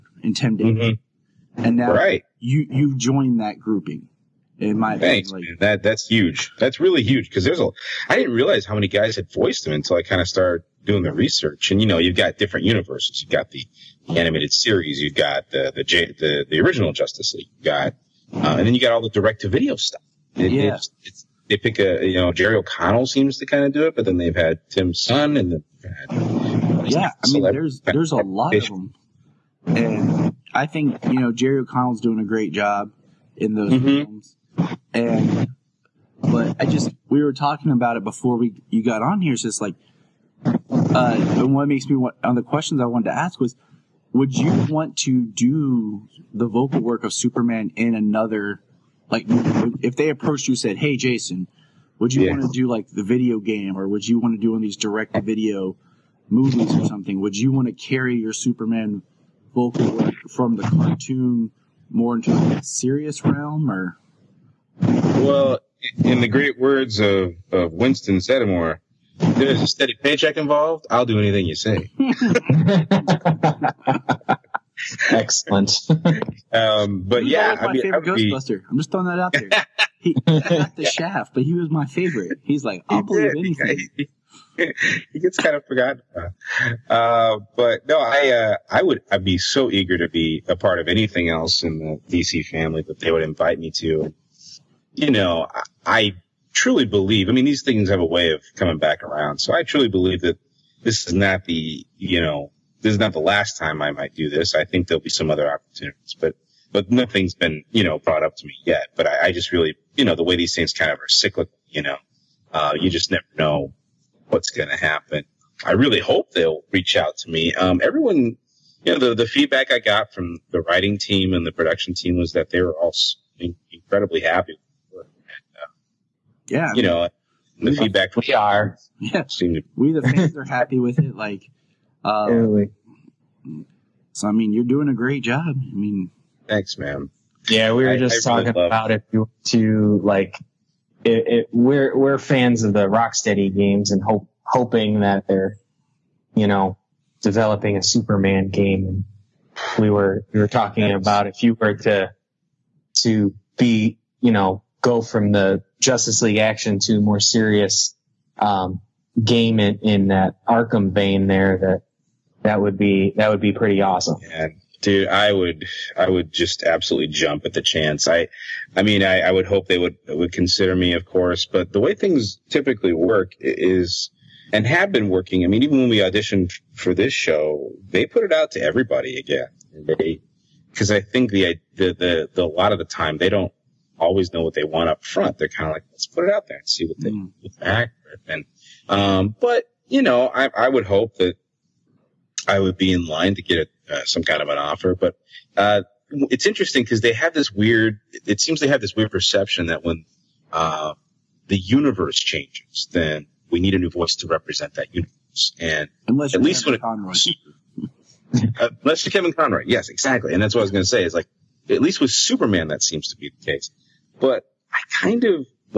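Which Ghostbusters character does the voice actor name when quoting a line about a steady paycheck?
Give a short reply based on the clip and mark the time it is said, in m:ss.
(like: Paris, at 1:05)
Winston Zeddemore, at 1:07.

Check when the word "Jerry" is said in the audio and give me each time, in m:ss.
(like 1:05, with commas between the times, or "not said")
0:22, 0:31.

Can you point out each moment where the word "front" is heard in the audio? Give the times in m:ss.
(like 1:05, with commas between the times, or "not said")
3:05.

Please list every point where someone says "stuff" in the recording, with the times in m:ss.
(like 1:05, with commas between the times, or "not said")
0:19.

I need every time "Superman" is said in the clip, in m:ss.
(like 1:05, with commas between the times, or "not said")
0:47, 0:58, 2:27, 3:32.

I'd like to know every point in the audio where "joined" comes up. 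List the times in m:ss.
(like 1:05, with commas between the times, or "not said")
0:02.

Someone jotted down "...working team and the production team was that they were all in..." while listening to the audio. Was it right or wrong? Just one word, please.
wrong.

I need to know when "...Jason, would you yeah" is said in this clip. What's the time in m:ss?
0:50.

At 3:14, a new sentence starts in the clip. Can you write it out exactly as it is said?
But uh, it's interesting because they have this weird.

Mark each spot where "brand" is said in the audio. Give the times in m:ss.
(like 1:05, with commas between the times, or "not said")
not said.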